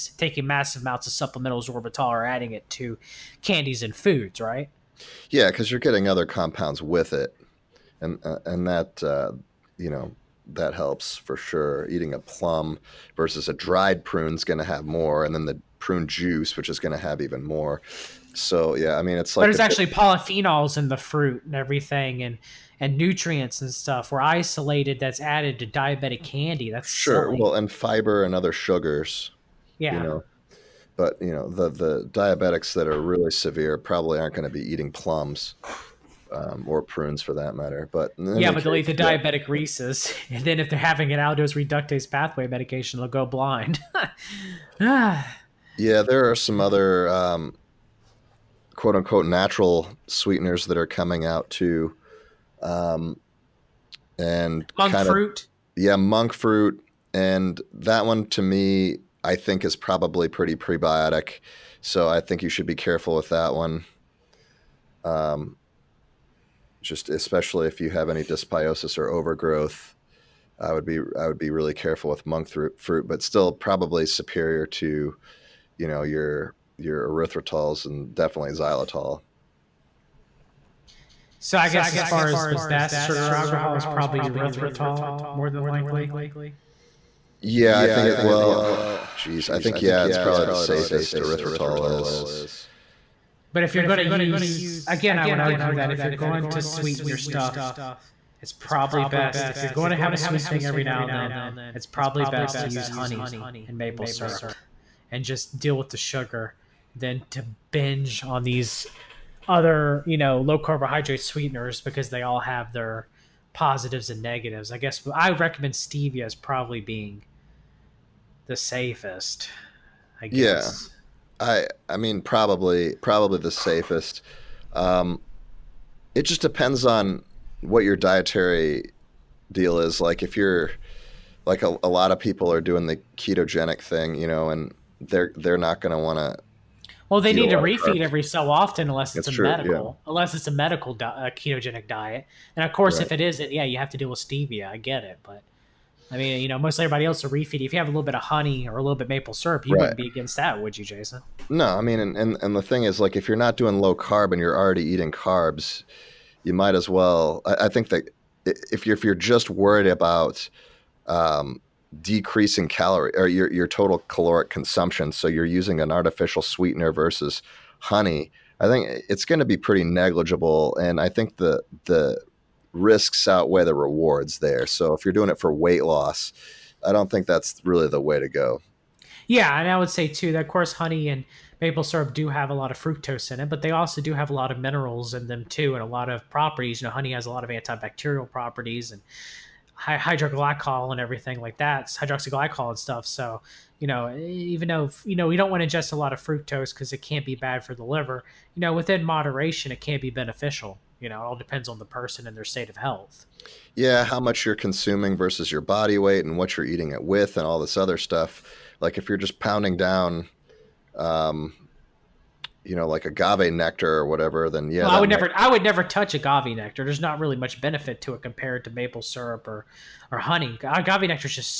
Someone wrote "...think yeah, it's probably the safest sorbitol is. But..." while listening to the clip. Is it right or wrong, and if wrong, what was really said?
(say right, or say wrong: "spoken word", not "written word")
wrong: "erythritol", not "sorbitol".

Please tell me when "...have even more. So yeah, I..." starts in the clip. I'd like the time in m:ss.
0:16.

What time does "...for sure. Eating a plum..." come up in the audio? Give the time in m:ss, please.
0:11.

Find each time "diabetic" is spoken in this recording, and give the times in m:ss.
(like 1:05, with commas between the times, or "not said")
0:25, 0:32, 0:38.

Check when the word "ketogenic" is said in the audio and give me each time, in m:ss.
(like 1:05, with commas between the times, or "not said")
2:13, 2:21.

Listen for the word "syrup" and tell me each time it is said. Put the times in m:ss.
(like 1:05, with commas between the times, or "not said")
1:44, 2:29, 3:01, 3:38.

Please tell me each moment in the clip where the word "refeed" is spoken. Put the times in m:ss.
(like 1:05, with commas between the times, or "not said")
2:17, 2:27.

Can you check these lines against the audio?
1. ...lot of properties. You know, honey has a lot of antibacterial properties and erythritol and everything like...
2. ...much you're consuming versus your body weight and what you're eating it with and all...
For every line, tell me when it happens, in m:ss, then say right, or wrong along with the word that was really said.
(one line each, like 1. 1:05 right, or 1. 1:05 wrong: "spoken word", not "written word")
1. 3:05 wrong: "hydroglycol", not "erythritol"
2. 3:24 right.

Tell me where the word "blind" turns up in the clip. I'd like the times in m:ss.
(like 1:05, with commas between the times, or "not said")
0:43.